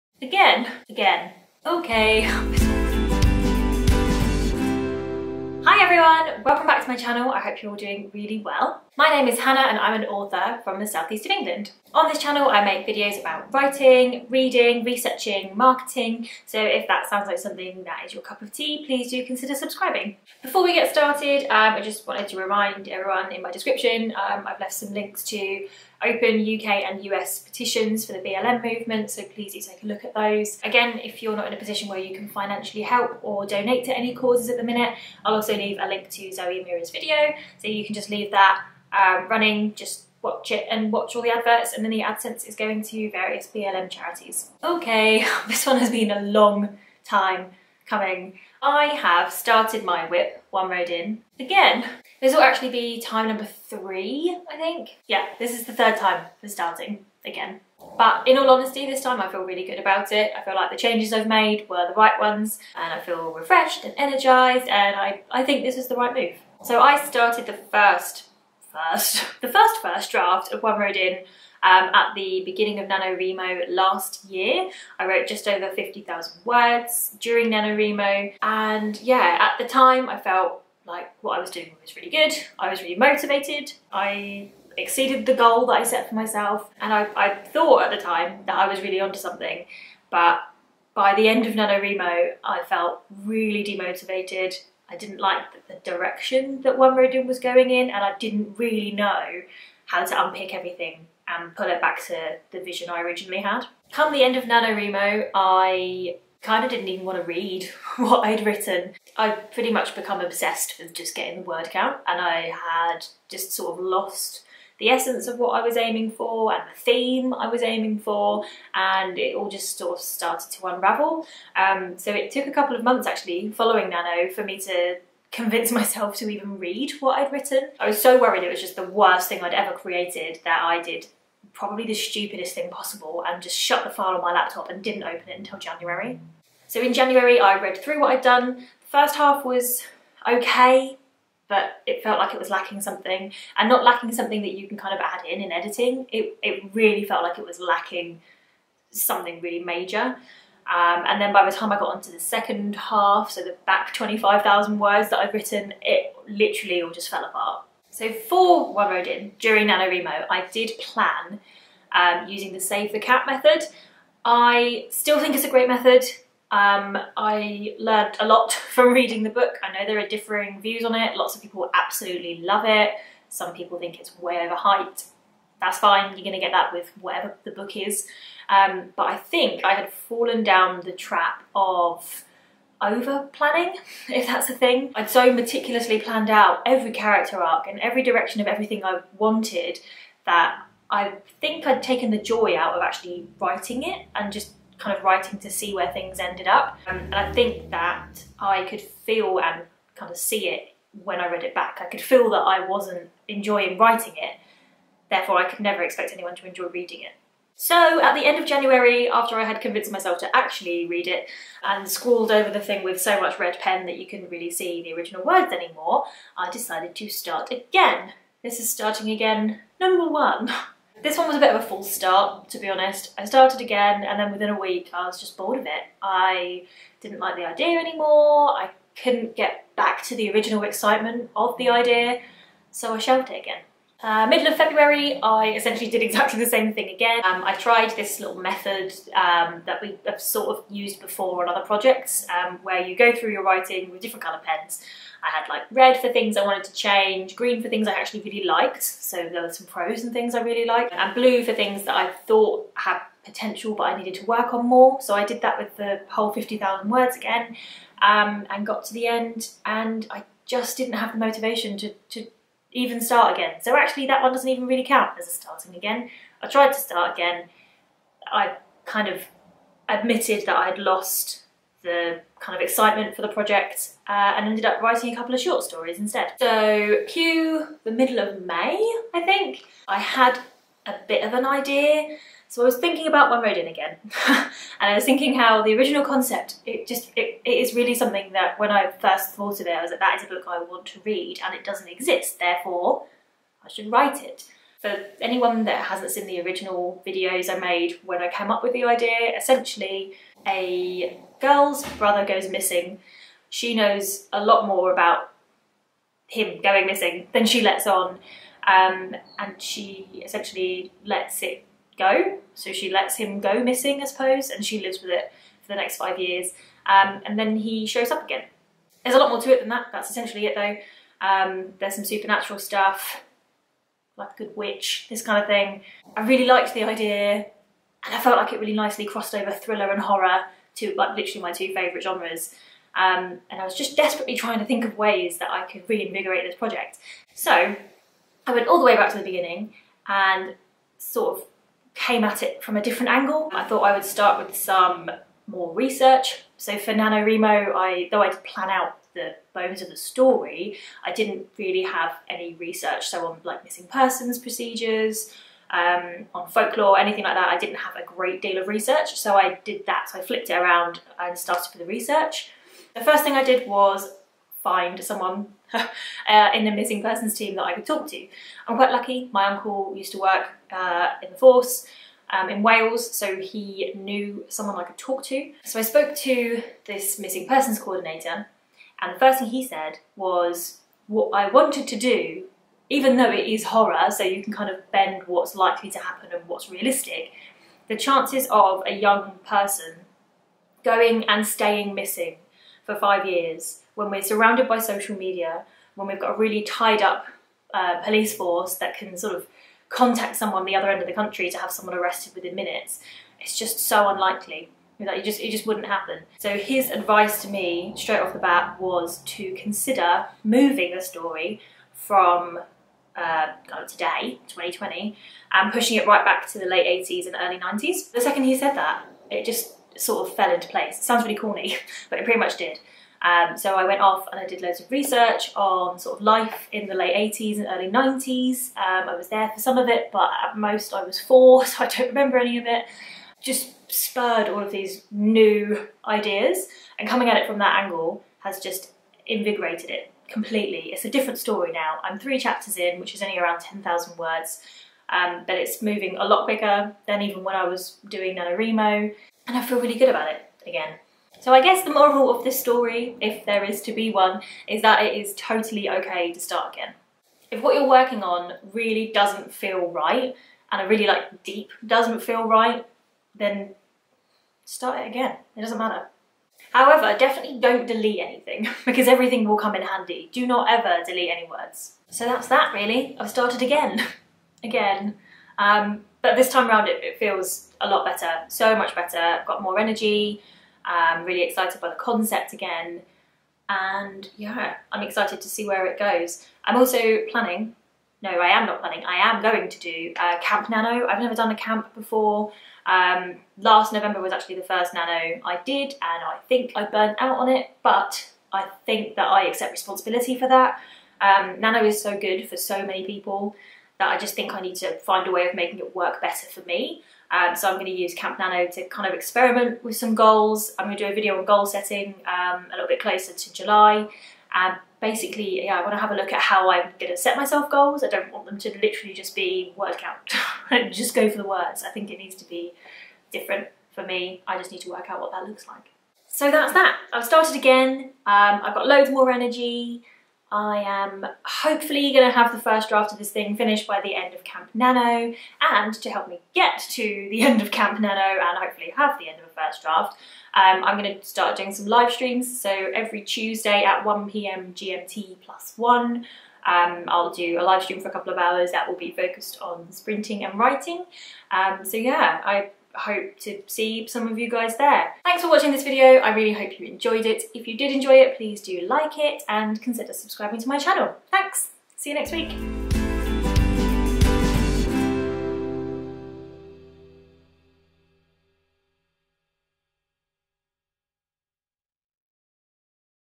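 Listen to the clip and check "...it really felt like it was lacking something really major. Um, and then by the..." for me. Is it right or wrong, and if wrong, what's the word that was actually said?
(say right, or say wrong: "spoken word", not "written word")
right.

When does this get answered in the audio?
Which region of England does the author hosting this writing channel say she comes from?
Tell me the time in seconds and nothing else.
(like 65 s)
10 s.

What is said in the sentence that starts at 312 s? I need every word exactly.
So she lets him go missing, I suppose, and she lives with it for the next five years.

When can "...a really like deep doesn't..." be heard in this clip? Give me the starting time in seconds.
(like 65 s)
460 s.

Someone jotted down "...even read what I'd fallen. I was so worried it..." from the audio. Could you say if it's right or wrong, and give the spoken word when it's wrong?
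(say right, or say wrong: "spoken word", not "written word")
wrong: "written", not "fallen".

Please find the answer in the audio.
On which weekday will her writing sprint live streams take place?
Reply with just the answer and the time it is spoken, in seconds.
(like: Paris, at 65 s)
Tuesday, at 543 s.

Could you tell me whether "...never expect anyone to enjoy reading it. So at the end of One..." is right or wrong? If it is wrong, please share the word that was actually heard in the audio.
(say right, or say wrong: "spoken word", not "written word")
wrong: "January", not "One".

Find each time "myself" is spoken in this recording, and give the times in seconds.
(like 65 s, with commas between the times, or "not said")
86 s, 125 s, 209 s, 517 s.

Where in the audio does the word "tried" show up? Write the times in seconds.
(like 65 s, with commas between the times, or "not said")
237 s, 266 s.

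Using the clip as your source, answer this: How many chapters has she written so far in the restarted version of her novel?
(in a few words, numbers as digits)
3.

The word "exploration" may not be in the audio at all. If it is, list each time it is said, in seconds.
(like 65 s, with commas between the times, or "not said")
not said.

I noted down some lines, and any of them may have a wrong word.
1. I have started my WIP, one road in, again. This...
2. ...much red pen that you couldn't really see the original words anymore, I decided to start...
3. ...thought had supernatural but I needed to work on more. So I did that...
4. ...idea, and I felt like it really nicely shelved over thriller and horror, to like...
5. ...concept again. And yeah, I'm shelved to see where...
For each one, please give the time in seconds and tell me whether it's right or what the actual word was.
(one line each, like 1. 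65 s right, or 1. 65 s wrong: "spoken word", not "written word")
1. 48 s right
2. 213 s right
3. 252 s wrong: "potential", not "supernatural"
4. 326 s wrong: "crossed", not "shelved"
5. 481 s wrong: "excited", not "shelved".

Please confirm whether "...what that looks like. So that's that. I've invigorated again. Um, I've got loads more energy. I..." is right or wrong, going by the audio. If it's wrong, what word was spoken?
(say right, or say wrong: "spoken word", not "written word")
wrong: "started", not "invigorated".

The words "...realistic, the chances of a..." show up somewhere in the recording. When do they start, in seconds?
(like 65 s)
386 s.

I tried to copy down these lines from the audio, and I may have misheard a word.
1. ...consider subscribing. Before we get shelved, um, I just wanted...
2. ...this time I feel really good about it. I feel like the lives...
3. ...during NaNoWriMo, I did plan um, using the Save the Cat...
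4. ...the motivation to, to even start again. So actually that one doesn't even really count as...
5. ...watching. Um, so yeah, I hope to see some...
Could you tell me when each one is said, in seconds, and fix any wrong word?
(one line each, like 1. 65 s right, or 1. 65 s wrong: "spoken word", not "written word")
1. 19 s wrong: "started", not "shelved"
2. 58 s wrong: "changes", not "lives"
3. 159 s right
4. 261 s right
5. 550 s wrong: "writing", not "watching".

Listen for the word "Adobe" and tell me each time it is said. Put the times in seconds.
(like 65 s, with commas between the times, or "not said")
not said.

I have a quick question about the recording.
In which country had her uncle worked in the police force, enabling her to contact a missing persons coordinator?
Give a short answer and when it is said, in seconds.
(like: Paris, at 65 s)
Wales, at 372 s.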